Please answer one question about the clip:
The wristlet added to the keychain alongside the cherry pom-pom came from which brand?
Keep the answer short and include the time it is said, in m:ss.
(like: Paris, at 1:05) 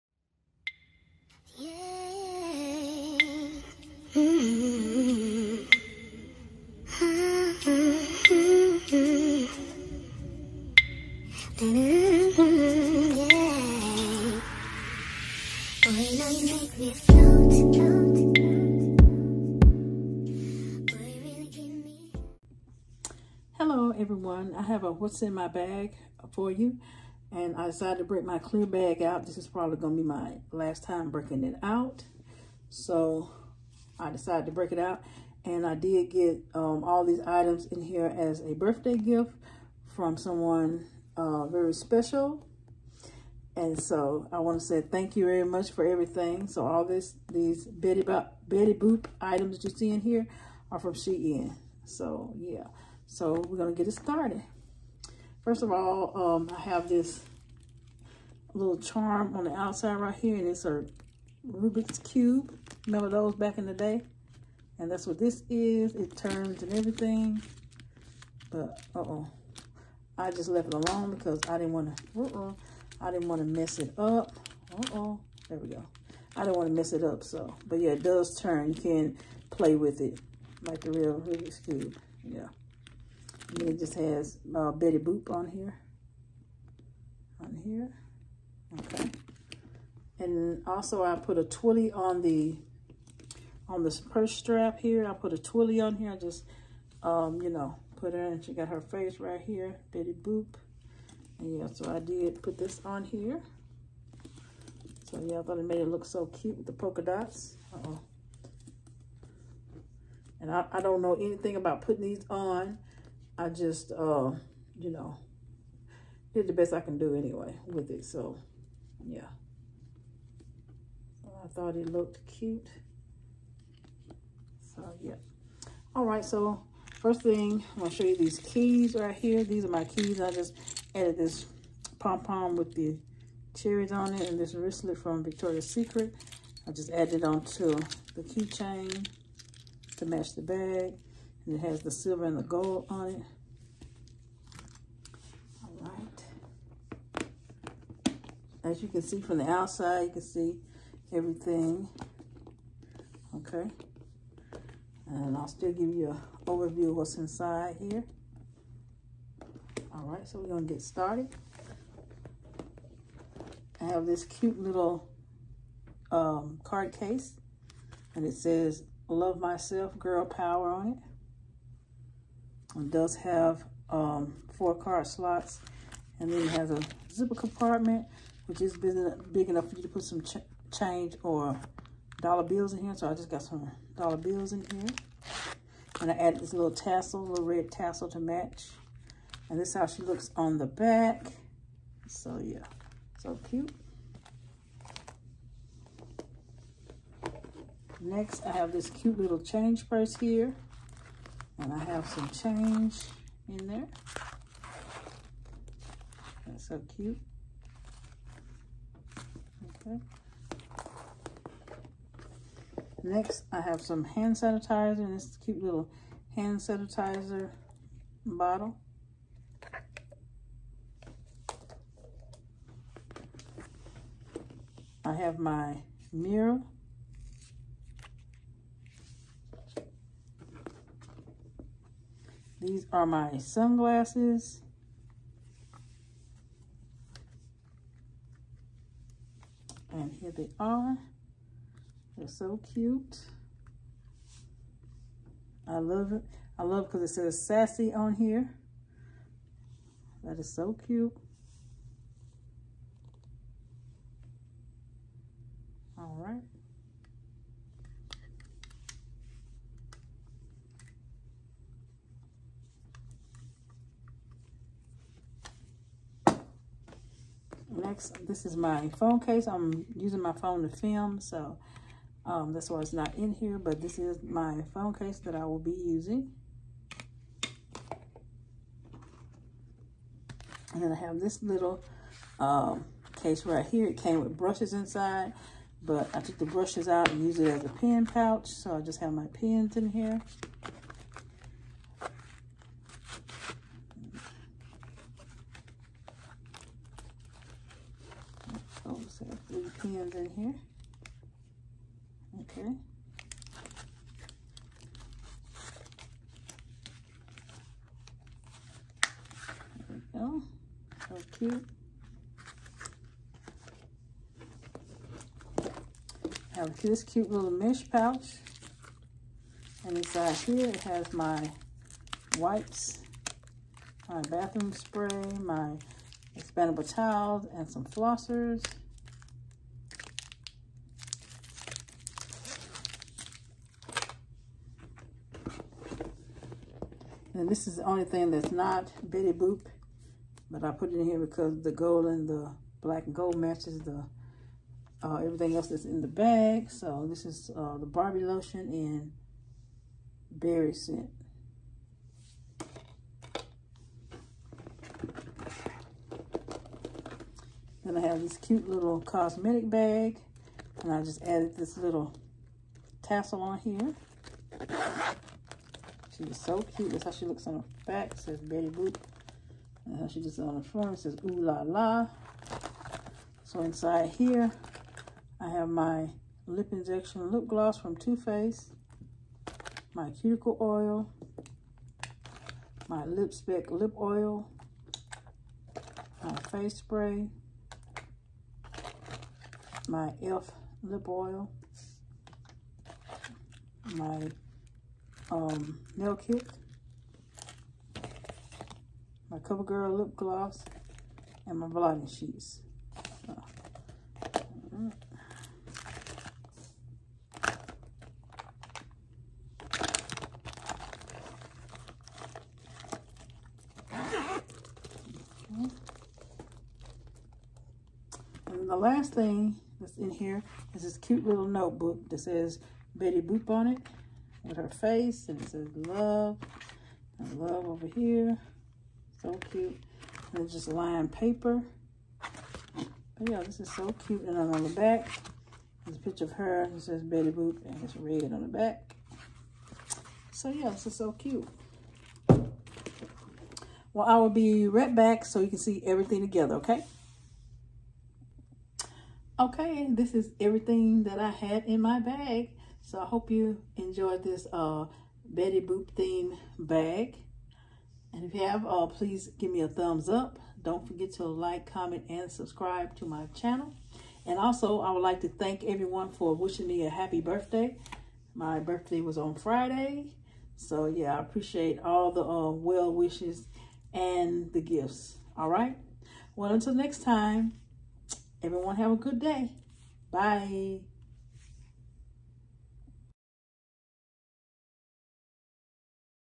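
Victoria's Secret, at 2:15.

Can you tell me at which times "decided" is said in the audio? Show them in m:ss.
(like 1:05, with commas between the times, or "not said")
0:27, 0:34.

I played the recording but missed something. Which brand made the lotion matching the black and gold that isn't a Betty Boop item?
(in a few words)
Barbie.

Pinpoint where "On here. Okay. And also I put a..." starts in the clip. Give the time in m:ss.
1:27.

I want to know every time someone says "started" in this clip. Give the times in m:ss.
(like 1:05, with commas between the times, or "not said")
0:53, 2:40.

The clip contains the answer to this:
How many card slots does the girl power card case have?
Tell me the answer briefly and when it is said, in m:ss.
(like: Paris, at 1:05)
4, at 2:54.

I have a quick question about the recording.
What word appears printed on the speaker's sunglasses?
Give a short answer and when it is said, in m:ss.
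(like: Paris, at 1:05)
sassy, at 4:07.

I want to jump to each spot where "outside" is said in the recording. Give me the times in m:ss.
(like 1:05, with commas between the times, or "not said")
0:59, 2:29.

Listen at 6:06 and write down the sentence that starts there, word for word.
That's how she looks on the back.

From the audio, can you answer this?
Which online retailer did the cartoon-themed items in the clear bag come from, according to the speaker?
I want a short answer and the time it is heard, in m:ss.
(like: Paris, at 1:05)
Shein, at 0:50.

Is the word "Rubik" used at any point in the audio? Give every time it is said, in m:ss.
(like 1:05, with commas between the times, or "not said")
1:01, 1:21.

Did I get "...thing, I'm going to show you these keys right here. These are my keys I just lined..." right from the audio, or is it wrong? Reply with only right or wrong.
wrong.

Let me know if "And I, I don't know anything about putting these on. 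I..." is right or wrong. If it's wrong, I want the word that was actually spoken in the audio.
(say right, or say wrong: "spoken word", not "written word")
right.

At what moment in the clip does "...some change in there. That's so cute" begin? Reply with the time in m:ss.
3:22.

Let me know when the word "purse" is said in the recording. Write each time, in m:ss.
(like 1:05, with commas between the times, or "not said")
1:33, 3:19.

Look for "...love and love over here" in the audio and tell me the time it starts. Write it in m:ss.
7:05.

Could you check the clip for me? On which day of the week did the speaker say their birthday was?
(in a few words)
Friday.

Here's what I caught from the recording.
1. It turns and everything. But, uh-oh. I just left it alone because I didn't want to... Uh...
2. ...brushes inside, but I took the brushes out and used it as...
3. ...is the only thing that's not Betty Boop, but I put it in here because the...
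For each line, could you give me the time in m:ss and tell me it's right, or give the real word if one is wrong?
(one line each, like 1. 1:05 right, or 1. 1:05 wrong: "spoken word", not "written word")
1. 1:05 right
2. 4:44 right
3. 5:37 right.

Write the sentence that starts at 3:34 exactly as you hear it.
And this cute little hand sanitizer bottle.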